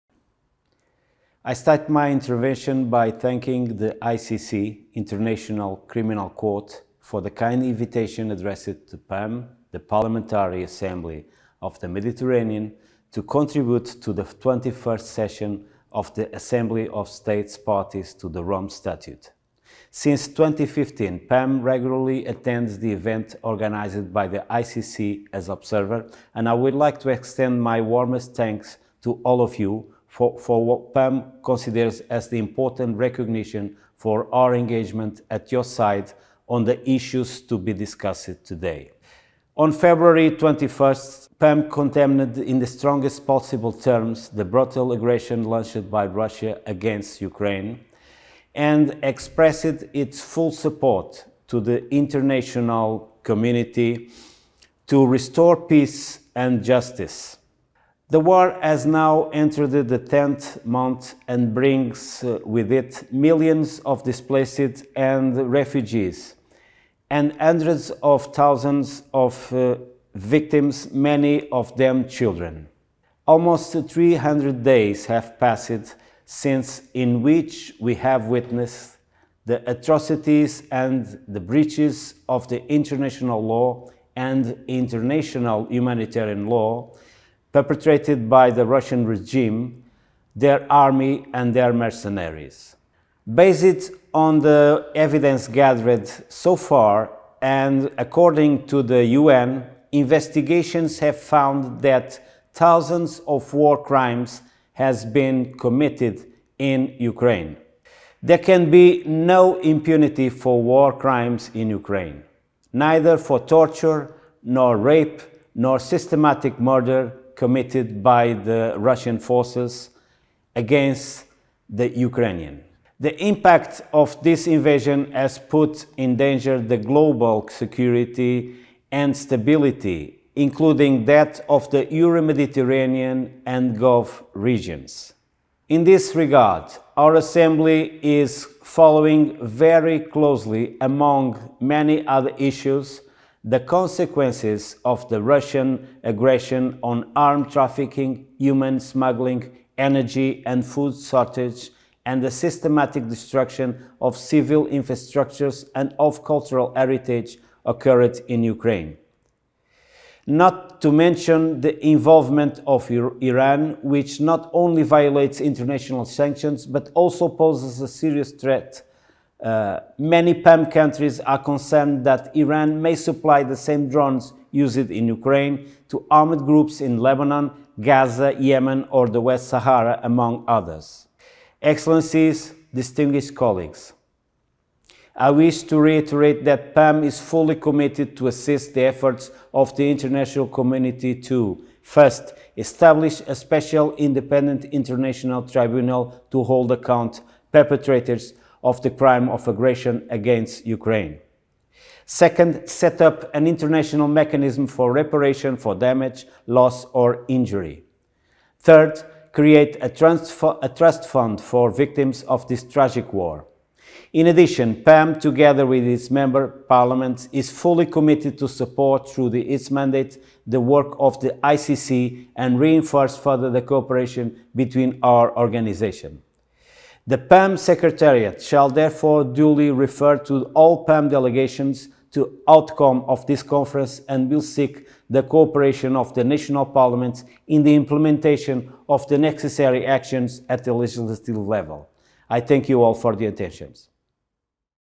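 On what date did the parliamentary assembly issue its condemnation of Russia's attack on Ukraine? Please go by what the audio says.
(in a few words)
February 21.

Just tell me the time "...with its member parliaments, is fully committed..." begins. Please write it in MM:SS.
03:35.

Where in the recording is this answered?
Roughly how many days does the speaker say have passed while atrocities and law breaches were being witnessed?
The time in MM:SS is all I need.
01:13.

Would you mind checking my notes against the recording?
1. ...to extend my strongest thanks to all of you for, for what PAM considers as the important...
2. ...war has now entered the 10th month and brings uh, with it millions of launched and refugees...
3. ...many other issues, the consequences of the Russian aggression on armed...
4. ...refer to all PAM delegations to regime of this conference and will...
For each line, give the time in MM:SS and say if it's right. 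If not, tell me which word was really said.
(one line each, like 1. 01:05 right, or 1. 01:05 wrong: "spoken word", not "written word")
1. 00:26 wrong: "warmest", not "strongest"
2. 00:58 wrong: "displaced", not "launched"
3. 02:21 right
4. 03:49 wrong: "outcome", not "regime".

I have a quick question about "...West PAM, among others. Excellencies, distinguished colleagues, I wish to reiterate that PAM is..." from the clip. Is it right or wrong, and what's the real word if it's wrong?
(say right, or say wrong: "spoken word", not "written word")
wrong: "Sahara", not "PAM".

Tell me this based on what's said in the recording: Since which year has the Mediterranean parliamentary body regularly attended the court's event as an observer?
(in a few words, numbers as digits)
2015.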